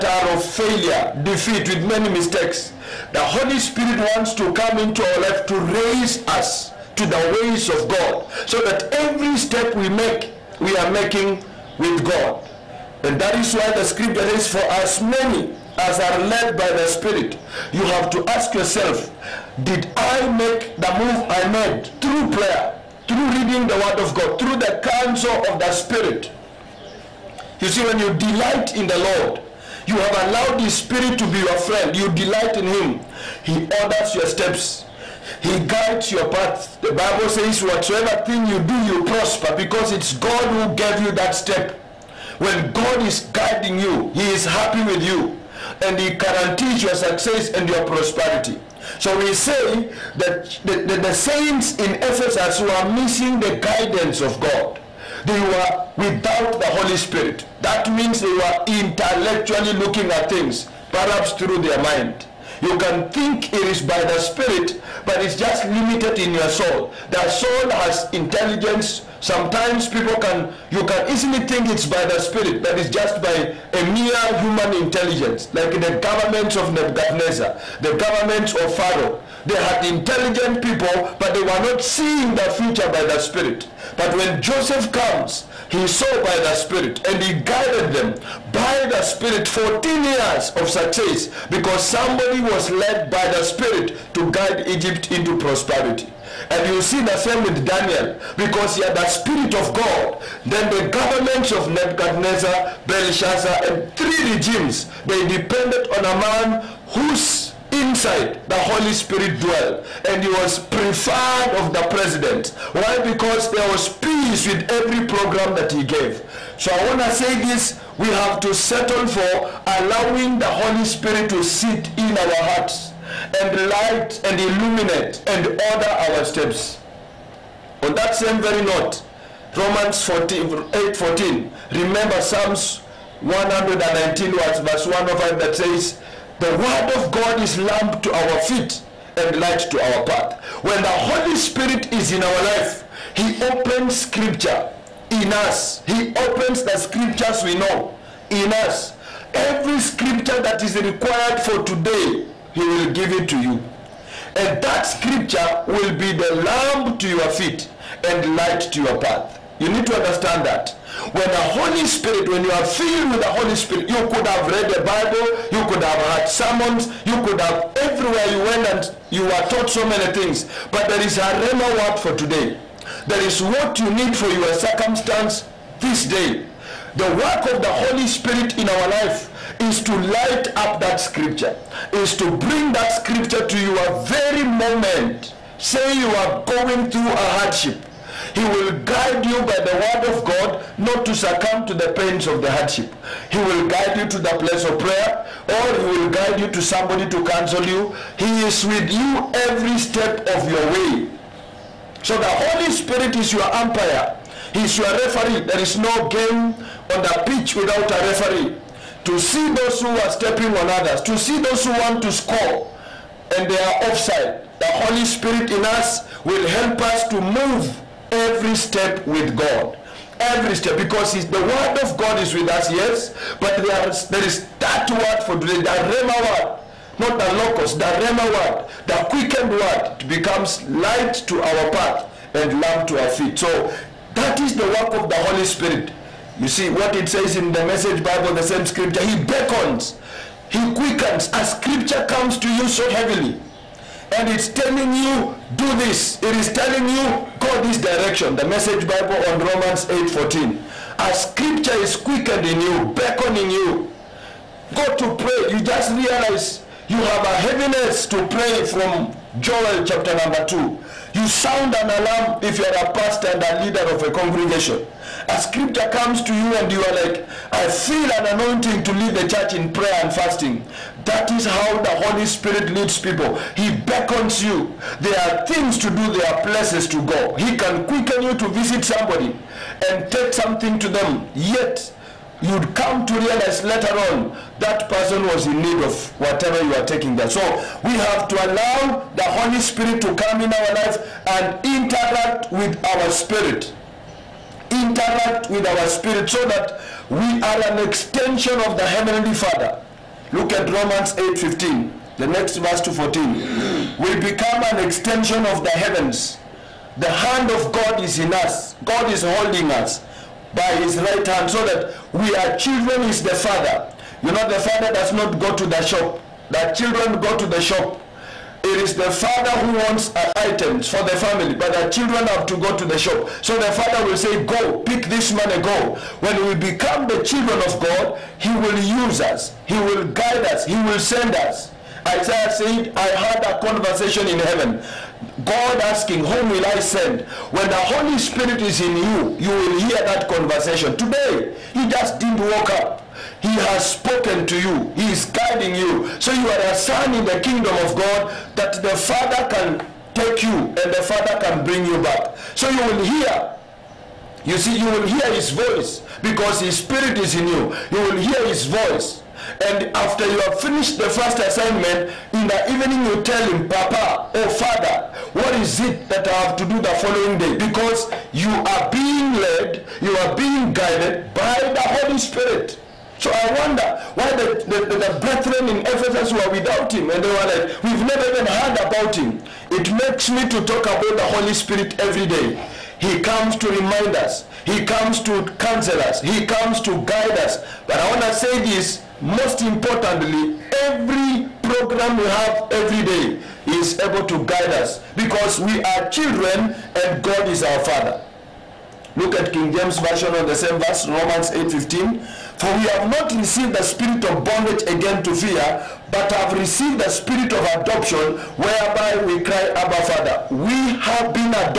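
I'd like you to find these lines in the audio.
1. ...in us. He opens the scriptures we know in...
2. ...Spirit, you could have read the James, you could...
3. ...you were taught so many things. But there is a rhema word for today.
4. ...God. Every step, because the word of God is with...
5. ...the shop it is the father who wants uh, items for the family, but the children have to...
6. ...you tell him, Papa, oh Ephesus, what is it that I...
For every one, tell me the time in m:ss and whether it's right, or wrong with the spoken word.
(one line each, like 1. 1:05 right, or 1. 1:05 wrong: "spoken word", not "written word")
1. 2:25 right
2. 2:43 wrong: "Bible", not "James"
3. 2:49 right
4. 3:39 right
5. 5:17 right
6. 6:03 wrong: "Father", not "Ephesus".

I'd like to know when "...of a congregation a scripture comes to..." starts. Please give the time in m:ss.
4:23.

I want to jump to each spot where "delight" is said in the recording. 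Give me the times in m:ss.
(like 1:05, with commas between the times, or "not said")
0:28, 0:32.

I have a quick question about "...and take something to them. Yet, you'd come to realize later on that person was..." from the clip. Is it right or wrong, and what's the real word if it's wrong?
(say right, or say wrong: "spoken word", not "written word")
right.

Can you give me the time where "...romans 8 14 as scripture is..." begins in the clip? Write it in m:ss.
4:09.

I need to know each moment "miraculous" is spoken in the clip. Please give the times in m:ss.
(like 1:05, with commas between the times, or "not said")
not said.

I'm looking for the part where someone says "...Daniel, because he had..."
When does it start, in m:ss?
1:37.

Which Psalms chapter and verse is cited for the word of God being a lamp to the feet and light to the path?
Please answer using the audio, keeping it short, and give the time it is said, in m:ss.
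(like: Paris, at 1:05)
Psalms 119:105, at 2:12.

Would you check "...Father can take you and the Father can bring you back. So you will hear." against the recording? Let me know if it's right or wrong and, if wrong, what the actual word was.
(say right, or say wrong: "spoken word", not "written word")
right.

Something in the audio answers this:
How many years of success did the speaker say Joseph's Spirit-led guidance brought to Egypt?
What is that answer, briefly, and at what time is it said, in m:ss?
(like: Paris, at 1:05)
14, at 1:29.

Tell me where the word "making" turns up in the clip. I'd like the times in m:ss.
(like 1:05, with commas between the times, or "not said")
0:10.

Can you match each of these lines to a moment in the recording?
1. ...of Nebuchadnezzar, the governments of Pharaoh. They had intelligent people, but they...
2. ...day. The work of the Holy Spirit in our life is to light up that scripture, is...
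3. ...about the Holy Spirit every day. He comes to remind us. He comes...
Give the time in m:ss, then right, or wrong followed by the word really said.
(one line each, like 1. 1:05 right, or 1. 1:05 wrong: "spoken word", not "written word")
1. 1:16 right
2. 2:56 right
3. 6:20 right.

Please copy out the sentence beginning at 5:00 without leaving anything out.
Look at Romans 8:15, the next verse to 14.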